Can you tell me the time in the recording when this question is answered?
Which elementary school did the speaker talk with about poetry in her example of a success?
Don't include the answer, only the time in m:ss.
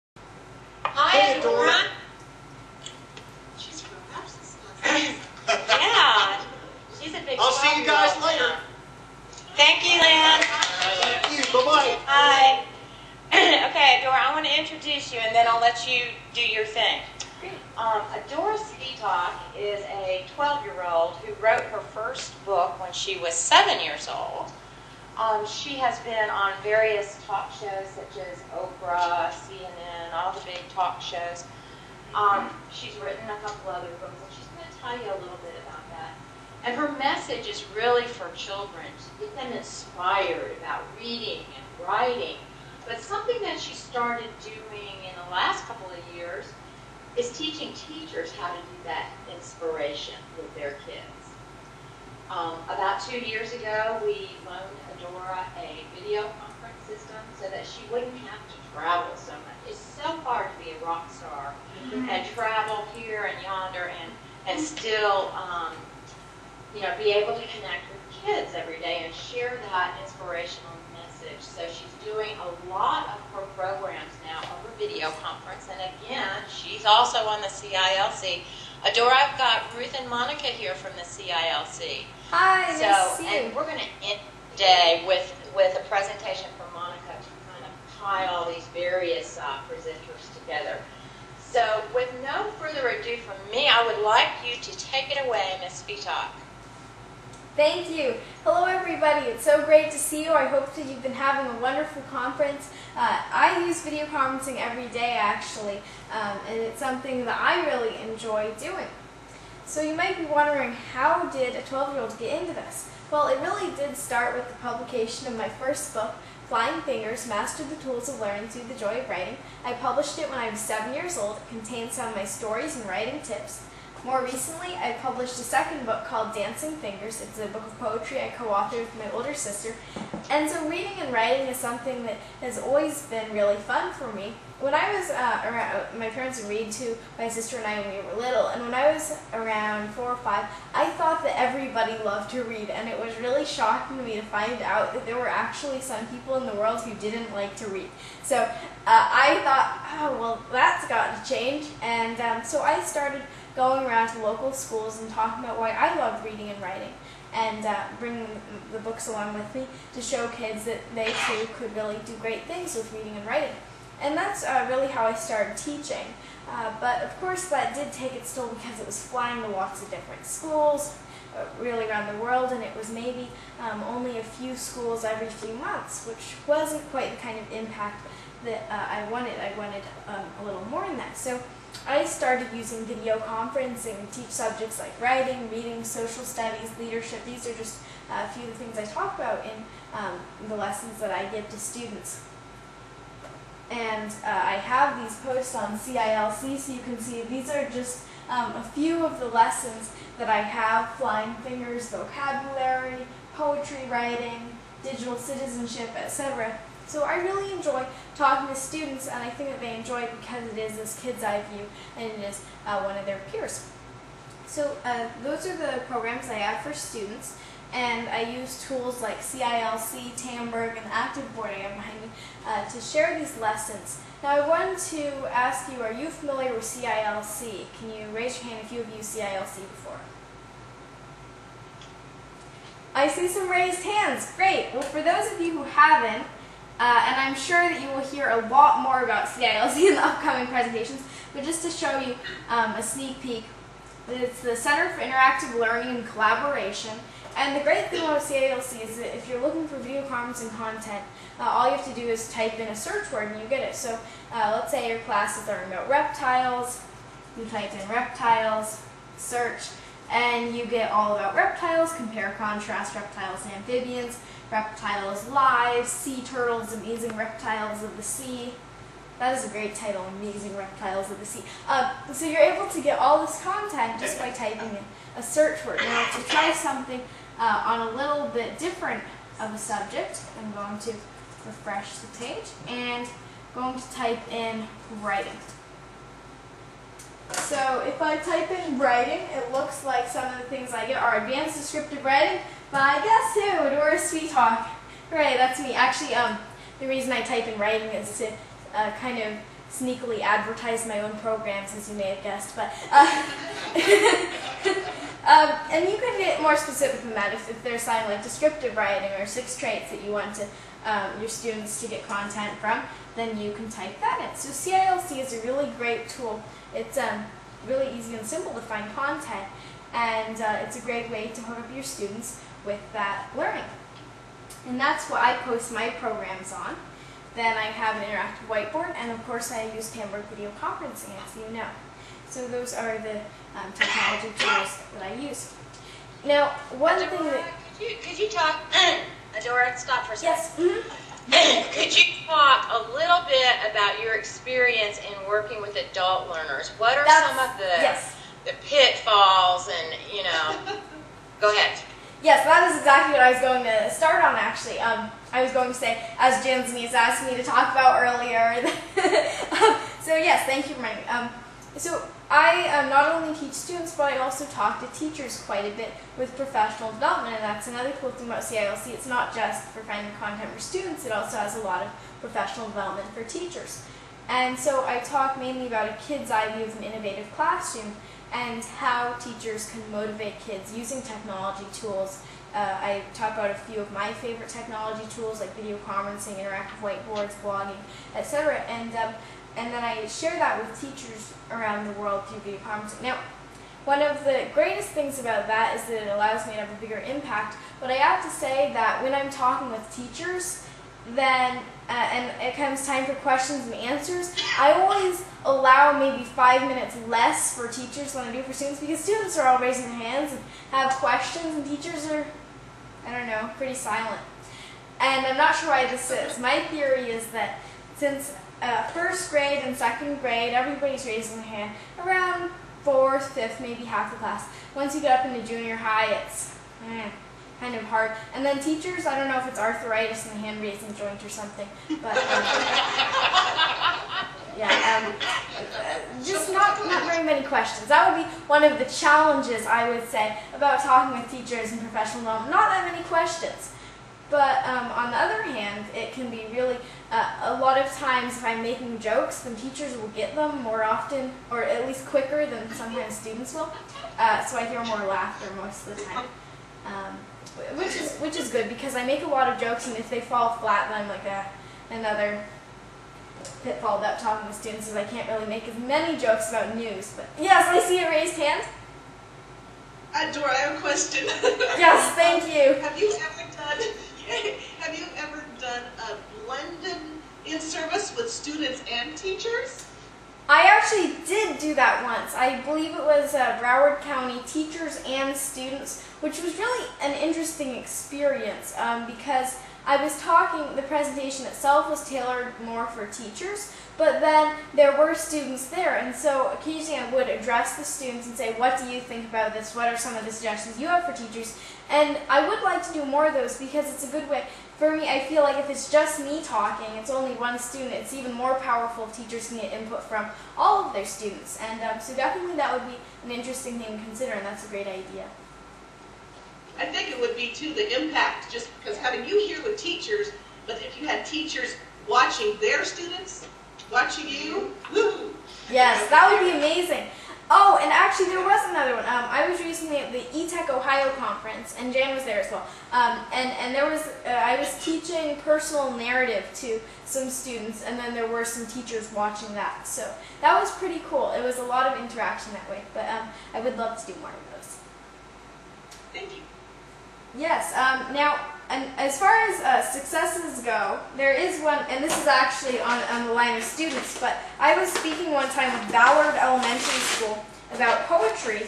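9:15.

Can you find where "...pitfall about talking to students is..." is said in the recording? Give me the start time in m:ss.
7:43.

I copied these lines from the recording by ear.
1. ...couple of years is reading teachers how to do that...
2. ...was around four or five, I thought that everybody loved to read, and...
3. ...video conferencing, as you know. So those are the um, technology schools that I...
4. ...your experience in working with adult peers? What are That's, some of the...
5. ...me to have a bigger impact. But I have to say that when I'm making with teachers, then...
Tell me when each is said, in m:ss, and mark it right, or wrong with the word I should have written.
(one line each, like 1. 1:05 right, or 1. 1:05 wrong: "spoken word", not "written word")
1. 0:45 wrong: "teaching", not "reading"
2. 2:18 right
3. 5:30 wrong: "tools", not "schools"
4. 5:44 wrong: "learners", not "peers"
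5. 6:36 wrong: "talking", not "making".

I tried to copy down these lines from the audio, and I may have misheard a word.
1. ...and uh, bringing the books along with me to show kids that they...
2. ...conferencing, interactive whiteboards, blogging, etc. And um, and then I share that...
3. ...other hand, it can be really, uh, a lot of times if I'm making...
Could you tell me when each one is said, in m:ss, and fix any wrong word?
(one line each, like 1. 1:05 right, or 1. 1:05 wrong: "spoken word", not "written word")
1. 2:37 right
2. 6:25 right
3. 7:25 right.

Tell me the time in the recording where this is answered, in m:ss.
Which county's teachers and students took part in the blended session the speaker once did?
8:03.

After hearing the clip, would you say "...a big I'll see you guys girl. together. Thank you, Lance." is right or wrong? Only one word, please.
wrong.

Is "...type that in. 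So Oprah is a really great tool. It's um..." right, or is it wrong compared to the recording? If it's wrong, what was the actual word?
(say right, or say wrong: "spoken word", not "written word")
wrong: "CILC", not "Oprah".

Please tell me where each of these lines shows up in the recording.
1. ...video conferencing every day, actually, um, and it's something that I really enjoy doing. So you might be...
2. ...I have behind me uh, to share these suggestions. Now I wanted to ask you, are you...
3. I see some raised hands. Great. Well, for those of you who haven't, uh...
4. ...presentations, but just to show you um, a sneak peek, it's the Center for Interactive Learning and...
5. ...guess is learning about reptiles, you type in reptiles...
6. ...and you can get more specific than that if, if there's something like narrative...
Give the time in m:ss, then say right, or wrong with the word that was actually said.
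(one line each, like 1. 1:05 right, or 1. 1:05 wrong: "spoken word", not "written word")
1. 1:43 right
2. 3:41 wrong: "lessons", not "suggestions"
3. 3:52 right
4. 4:00 right
5. 4:15 wrong: "class", not "guess"
6. 5:05 wrong: "descriptive", not "narrative".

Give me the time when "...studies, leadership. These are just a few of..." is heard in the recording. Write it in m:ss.
3:06.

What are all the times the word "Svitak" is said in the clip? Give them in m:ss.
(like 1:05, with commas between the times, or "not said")
0:18, 1:35.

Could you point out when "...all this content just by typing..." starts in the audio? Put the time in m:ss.
4:32.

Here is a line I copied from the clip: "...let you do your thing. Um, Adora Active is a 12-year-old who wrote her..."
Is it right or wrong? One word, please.
wrong.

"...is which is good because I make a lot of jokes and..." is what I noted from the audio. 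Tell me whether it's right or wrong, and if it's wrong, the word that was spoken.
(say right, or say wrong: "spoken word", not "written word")
right.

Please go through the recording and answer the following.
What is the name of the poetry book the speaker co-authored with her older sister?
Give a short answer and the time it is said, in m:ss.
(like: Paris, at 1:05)
Dancing Fingers, at 2:06.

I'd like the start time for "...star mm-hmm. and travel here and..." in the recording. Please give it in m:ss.
1:01.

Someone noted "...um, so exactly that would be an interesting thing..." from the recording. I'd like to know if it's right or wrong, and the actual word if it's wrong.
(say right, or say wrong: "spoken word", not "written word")
wrong: "definitely", not "exactly".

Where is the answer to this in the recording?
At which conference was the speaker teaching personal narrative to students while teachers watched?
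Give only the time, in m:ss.
8:50.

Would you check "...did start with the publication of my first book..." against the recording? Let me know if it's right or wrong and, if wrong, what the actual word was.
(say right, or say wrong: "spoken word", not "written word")
right.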